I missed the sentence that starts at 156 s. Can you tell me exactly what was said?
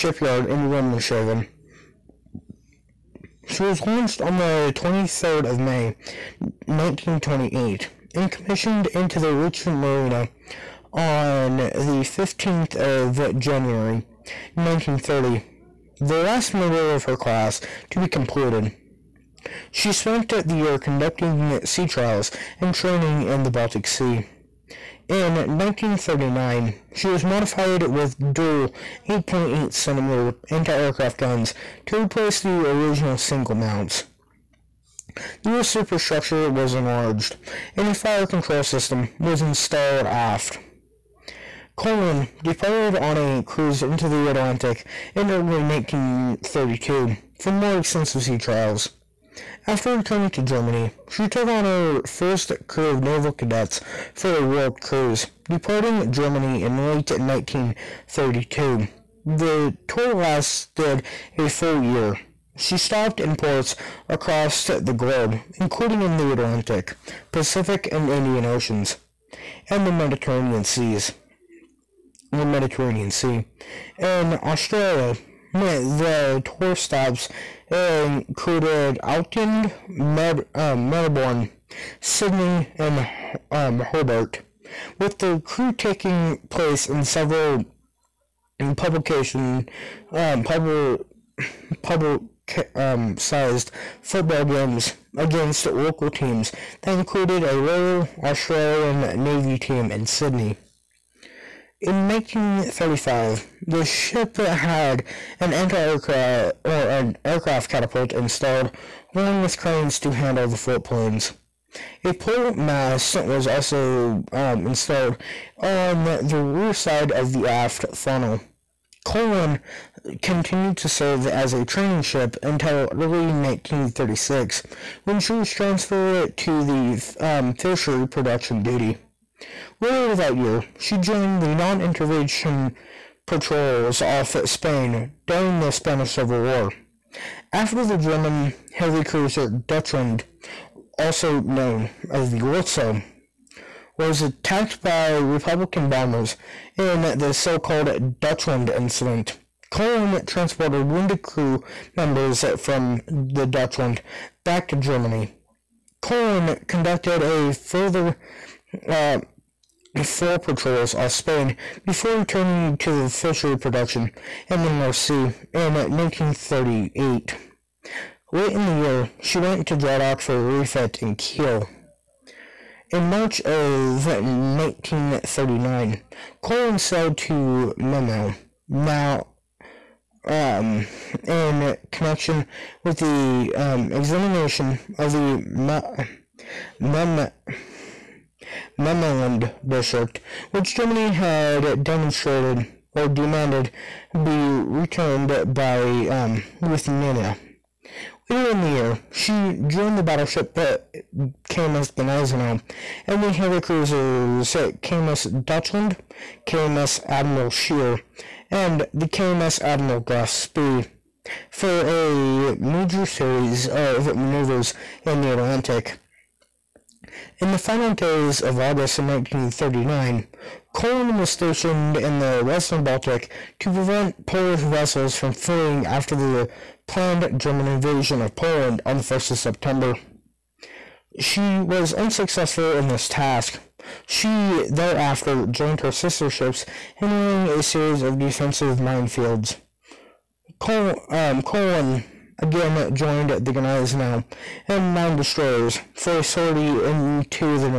Köln conducted a further uh, four patrols off Spain before returning to the fishery production in the North Sea in 1938.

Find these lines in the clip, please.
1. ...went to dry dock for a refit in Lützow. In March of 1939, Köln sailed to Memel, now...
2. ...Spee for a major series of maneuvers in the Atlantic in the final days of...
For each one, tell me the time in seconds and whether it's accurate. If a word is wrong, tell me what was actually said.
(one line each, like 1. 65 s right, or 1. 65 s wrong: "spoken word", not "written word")
1. 169 s wrong: "Kiel", not "Lützow"
2. 210 s right.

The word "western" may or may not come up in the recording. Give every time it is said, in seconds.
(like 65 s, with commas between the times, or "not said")
222 s.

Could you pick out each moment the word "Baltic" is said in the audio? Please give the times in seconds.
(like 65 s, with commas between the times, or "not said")
23 s, 222 s.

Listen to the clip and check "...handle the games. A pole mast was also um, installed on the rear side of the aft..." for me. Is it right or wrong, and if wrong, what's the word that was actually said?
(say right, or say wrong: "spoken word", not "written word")
wrong: "floatplanes", not "games".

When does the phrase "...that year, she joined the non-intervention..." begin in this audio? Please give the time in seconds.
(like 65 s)
130 s.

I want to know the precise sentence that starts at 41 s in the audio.
Köln departed on a cruise into the Atlantic in early 1932 for more extensive sea trials.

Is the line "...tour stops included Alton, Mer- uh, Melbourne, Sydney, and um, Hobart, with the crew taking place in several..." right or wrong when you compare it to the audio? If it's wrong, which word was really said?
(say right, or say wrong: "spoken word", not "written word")
right.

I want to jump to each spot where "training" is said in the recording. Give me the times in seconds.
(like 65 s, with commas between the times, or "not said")
22 s, 121 s.